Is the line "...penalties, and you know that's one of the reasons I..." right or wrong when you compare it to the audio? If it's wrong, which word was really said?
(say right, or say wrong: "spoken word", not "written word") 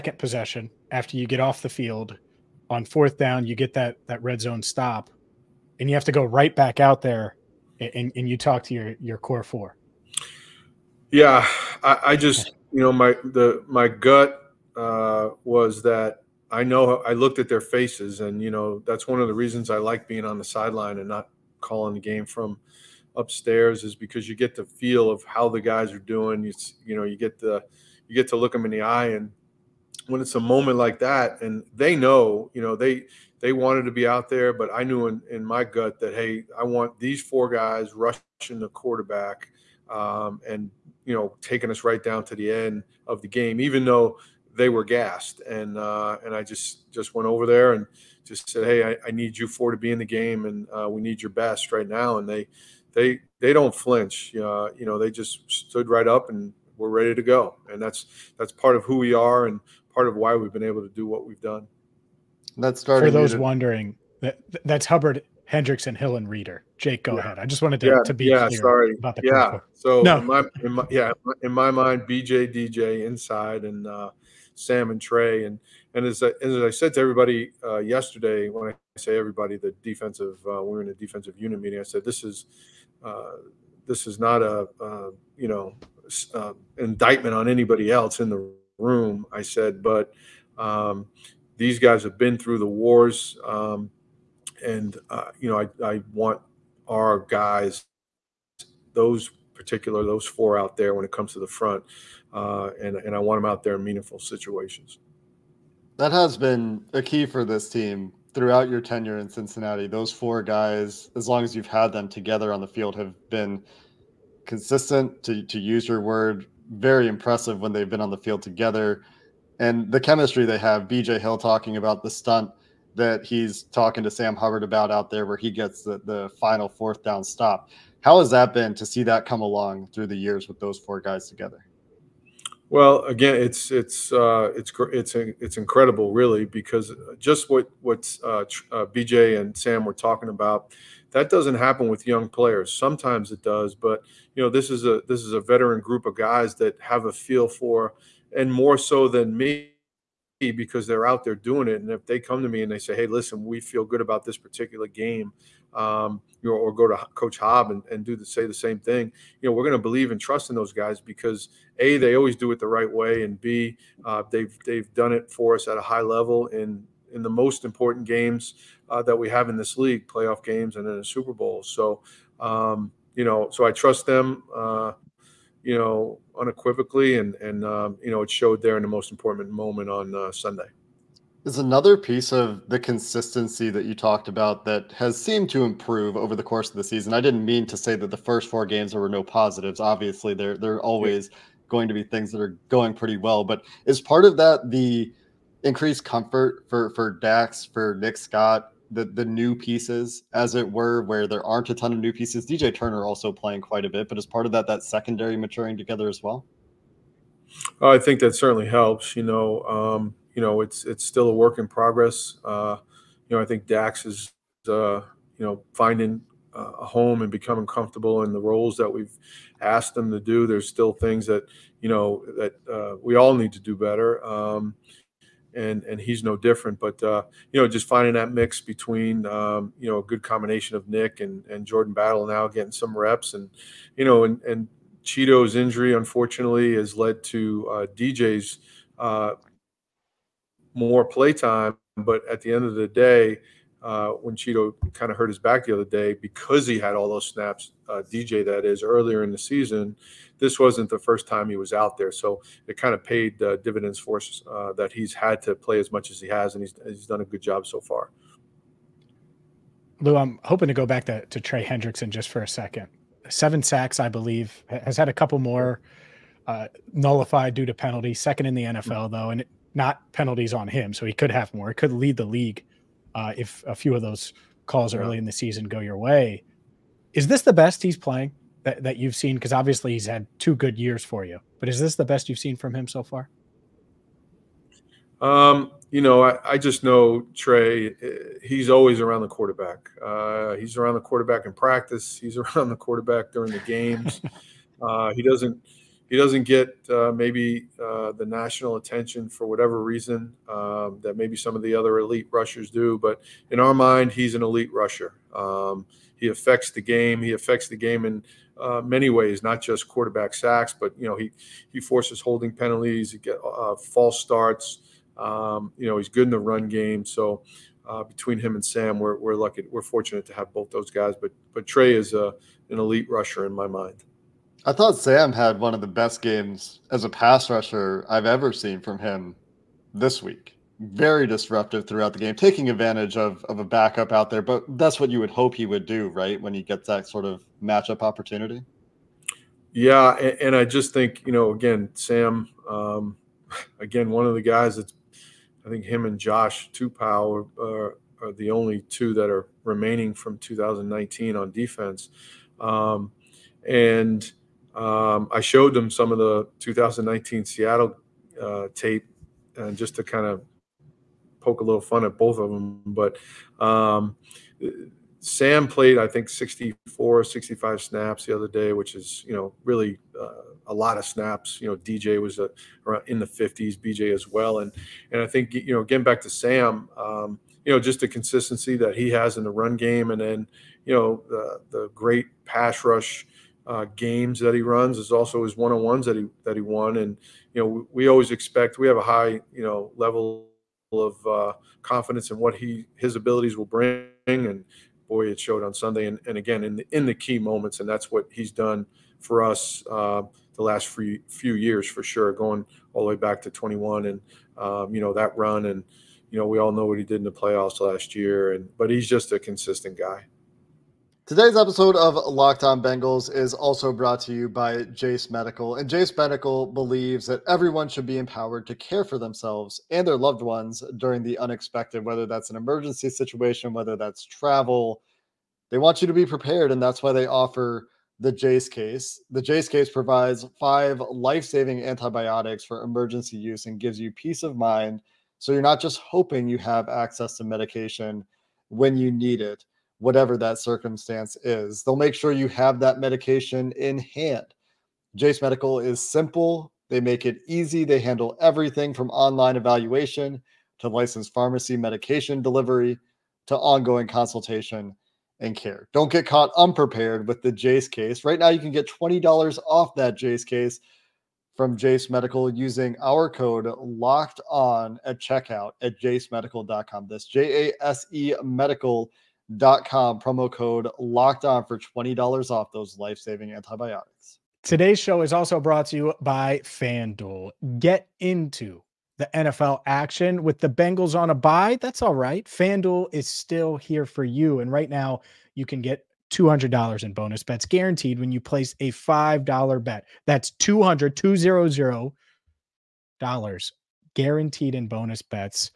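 wrong: "faces", not "penalties".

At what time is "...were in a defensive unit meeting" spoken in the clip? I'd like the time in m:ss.
1:20.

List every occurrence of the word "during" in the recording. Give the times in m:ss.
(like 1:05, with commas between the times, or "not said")
4:53, 7:00.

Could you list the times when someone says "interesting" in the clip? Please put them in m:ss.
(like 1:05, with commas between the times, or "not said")
not said.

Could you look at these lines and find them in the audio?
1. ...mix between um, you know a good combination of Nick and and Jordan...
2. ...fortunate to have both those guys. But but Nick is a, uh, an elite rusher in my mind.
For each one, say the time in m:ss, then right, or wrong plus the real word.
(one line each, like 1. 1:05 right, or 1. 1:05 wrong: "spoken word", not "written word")
1. 3:48 right
2. 5:19 wrong: "Trey", not "Nick".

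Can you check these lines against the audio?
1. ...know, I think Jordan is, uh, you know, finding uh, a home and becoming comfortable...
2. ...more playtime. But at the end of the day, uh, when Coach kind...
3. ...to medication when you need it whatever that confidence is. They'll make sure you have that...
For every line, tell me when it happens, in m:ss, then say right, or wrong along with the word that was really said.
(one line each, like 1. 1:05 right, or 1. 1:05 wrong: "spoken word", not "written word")
1. 3:33 wrong: "Dax", not "Jordan"
2. 4:00 wrong: "Chido", not "Coach"
3. 7:17 wrong: "circumstance", not "confidence".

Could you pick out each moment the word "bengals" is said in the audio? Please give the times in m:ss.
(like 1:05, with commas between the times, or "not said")
6:52, 8:00.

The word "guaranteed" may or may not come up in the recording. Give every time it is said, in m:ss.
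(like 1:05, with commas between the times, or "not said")
8:07, 8:14.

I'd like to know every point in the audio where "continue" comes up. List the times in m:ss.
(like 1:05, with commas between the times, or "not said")
not said.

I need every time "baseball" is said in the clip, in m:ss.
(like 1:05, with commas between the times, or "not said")
not said.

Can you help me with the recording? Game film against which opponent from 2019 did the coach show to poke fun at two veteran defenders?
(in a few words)
Seattle.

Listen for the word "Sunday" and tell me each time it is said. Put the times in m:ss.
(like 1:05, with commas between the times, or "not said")
3:00, 6:35.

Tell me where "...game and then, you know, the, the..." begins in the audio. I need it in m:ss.
6:19.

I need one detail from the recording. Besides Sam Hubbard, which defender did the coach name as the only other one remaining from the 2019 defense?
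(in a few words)
Josh Tupou.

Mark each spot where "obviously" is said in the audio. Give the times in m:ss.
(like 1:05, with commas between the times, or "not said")
3:09, 4:39.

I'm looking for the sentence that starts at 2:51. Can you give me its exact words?
So, um, you know, so I trust them.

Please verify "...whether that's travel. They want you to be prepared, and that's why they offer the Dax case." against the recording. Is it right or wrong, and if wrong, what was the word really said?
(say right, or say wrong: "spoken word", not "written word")
wrong: "Jase", not "Dax".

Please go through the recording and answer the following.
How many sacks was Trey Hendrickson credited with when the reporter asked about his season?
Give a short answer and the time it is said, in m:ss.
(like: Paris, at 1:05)
7, at 4:23.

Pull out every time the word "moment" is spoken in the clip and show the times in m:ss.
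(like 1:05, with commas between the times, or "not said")
0:30, 2:59, 6:37.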